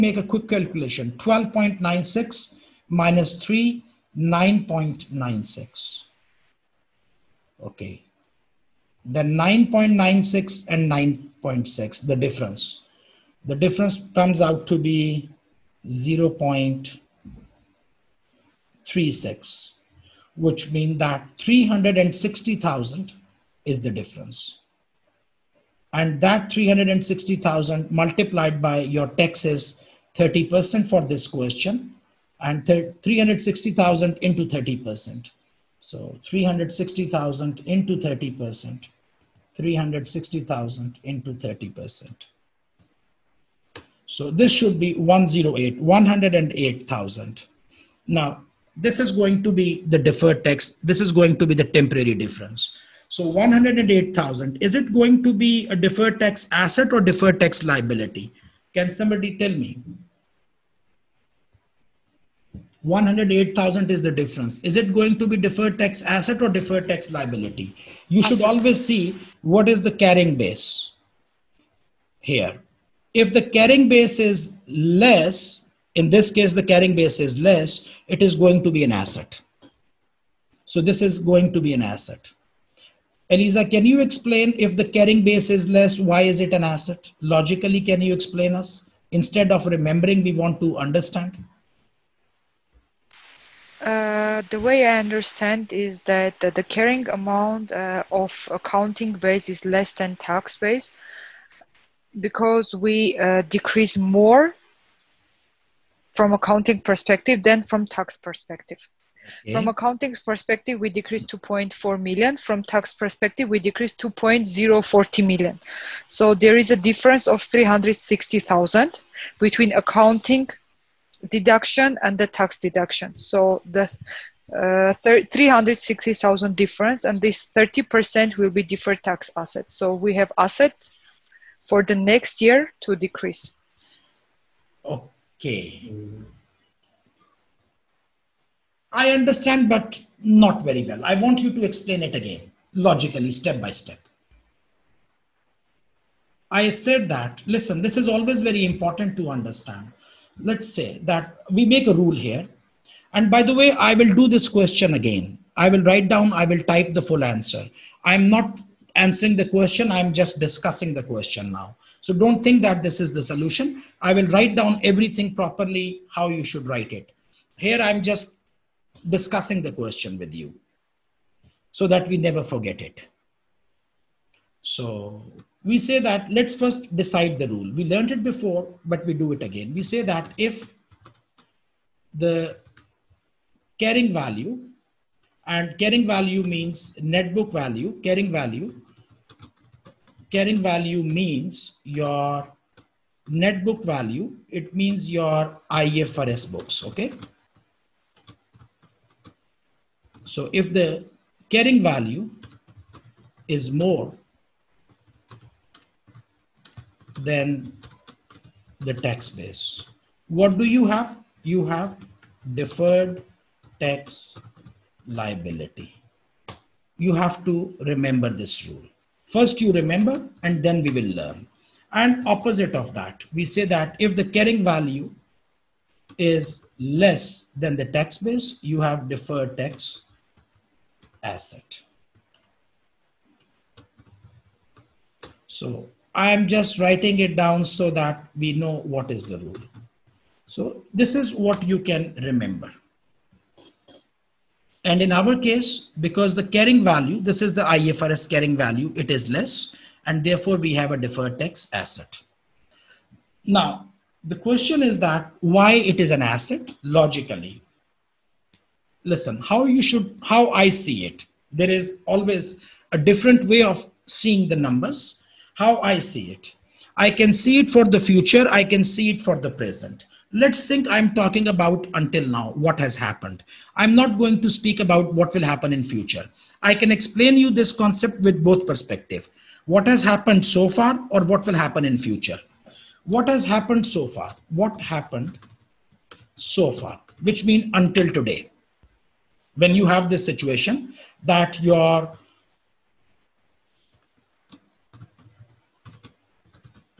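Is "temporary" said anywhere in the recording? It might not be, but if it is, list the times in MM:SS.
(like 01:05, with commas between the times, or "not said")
00:51.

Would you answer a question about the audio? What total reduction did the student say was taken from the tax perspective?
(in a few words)
2.040 million.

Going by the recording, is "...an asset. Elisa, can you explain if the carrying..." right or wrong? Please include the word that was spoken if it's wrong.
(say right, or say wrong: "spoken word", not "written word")
right.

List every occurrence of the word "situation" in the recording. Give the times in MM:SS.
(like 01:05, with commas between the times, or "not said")
04:50.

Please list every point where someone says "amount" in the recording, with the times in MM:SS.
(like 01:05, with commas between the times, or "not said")
01:37.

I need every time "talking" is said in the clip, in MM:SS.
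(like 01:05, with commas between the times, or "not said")
04:31.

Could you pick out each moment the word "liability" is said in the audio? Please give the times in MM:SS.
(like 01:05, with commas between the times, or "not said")
00:57, 01:07, 03:35.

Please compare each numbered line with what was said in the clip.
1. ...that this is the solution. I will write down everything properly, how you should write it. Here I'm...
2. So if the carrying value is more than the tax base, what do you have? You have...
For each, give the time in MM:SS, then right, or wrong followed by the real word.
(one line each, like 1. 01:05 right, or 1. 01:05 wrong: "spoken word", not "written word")
1. 02:42 right
2. 03:20 right.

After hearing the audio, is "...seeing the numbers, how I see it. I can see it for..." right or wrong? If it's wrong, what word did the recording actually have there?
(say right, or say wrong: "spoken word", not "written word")
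right.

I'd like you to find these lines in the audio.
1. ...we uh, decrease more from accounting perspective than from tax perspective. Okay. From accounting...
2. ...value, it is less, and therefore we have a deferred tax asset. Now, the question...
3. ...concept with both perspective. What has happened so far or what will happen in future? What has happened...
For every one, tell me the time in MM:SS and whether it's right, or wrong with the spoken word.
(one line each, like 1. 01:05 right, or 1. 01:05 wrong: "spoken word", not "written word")
1. 01:42 right
2. 04:08 right
3. 04:37 right.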